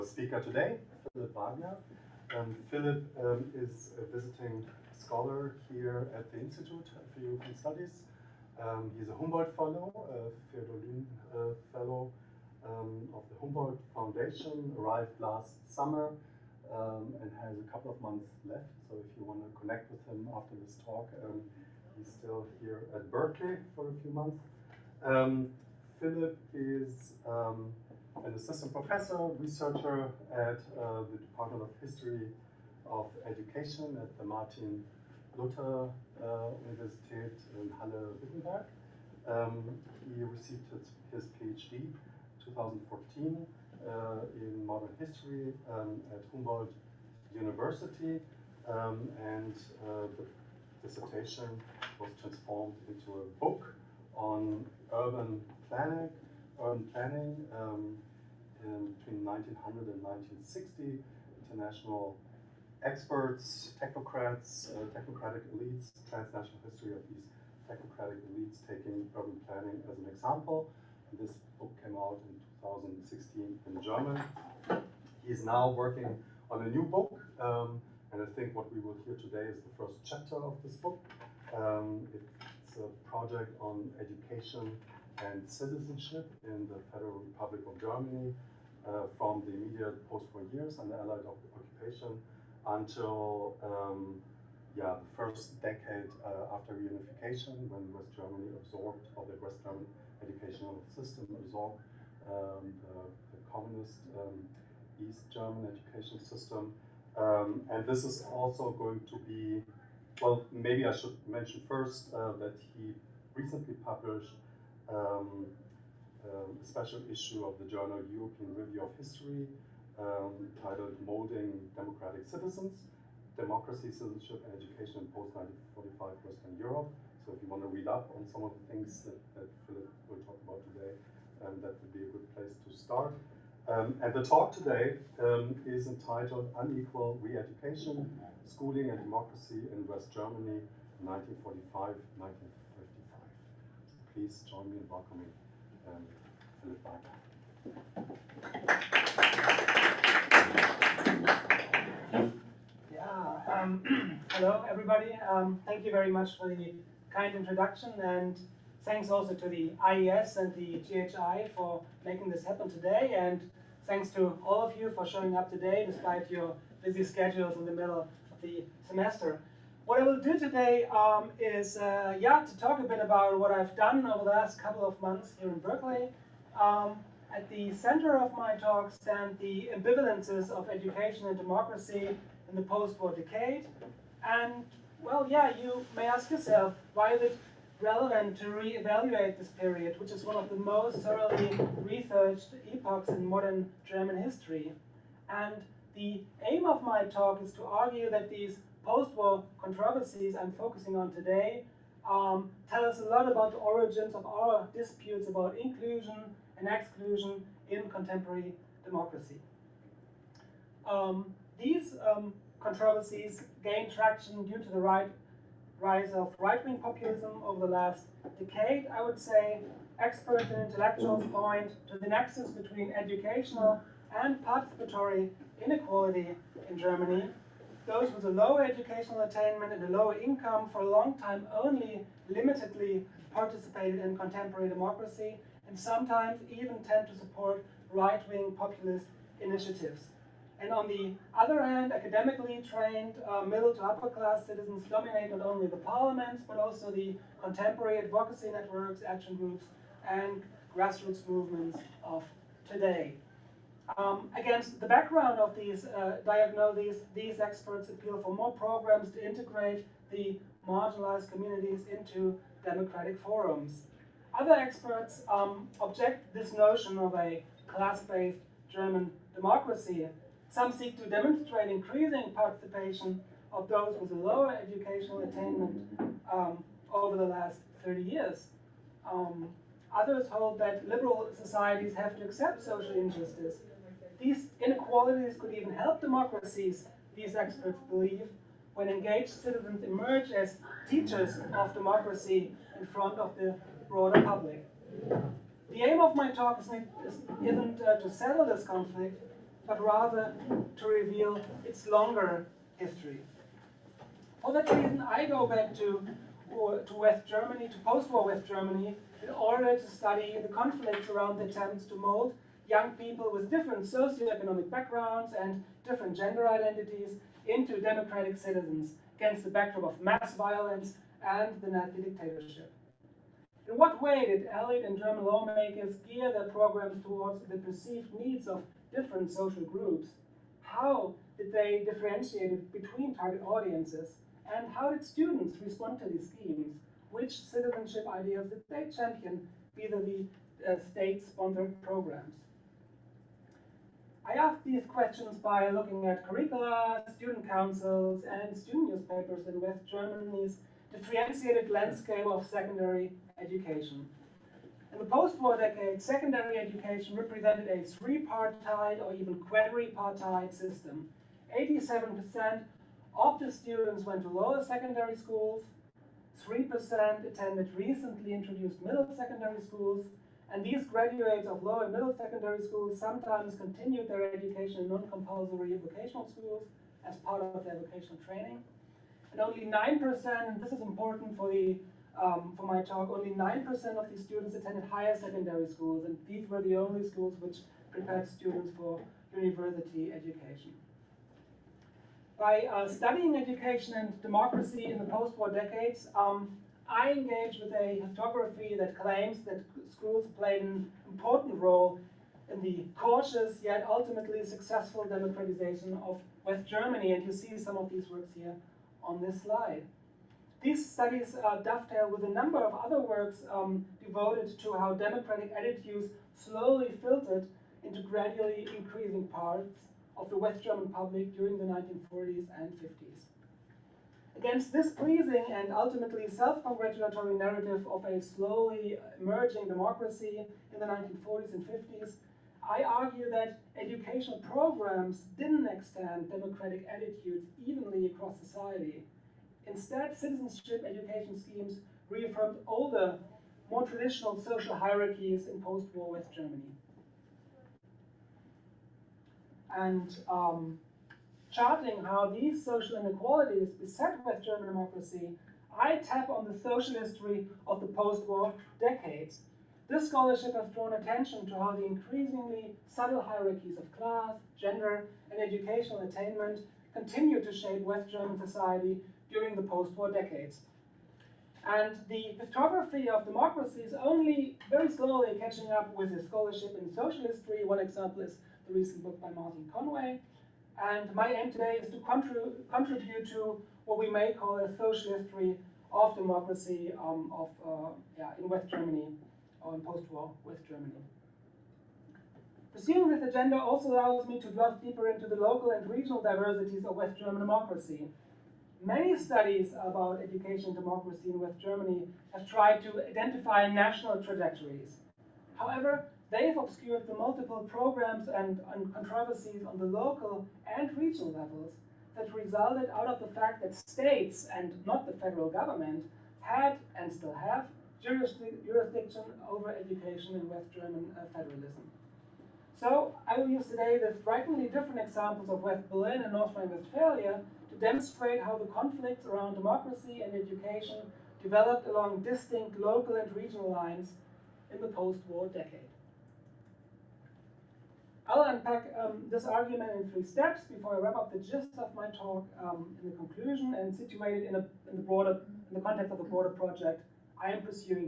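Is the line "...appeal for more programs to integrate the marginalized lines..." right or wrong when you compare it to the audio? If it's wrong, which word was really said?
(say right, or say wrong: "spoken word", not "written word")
wrong: "communities", not "lines".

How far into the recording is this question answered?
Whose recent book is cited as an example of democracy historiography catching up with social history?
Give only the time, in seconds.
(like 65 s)
479 s.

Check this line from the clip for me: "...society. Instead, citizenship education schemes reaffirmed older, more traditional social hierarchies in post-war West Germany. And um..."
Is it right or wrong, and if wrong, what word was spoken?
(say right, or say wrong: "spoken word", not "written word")
right.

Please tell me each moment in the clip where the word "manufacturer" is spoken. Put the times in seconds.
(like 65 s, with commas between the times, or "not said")
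not said.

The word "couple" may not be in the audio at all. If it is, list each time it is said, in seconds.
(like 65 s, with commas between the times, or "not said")
17 s, 174 s.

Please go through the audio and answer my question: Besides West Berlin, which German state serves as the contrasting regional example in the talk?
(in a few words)
North Rhine-Westphalia.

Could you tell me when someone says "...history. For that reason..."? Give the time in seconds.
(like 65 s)
302 s.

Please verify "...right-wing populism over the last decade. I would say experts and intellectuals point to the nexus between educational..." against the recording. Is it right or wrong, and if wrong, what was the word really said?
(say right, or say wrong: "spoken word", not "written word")
right.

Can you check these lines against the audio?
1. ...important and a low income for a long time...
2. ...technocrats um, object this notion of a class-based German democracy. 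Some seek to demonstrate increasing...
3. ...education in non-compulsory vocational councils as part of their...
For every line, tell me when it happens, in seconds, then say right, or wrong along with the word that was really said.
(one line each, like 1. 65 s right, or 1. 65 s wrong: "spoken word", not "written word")
1. 229 s wrong: "attainment", not "important"
2. 264 s wrong: "experts", not "technocrats"
3. 374 s wrong: "schools", not "councils".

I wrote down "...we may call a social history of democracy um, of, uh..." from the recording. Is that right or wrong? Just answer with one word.
right.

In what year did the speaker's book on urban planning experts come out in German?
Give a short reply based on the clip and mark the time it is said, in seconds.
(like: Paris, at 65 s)
2016, at 72 s.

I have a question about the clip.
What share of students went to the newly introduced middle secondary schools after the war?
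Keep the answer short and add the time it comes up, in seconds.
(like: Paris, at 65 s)
3%, at 366 s.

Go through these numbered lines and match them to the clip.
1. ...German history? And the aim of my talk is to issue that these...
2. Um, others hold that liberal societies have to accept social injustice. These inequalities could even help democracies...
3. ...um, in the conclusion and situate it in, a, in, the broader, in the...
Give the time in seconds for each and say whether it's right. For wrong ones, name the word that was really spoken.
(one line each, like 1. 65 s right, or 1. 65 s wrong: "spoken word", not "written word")
1. 193 s wrong: "argue", not "issue"
2. 279 s right
3. 542 s right.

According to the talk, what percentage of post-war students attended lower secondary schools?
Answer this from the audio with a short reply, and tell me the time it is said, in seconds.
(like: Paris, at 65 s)
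87%, at 361 s.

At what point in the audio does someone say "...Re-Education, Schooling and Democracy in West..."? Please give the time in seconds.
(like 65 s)
137 s.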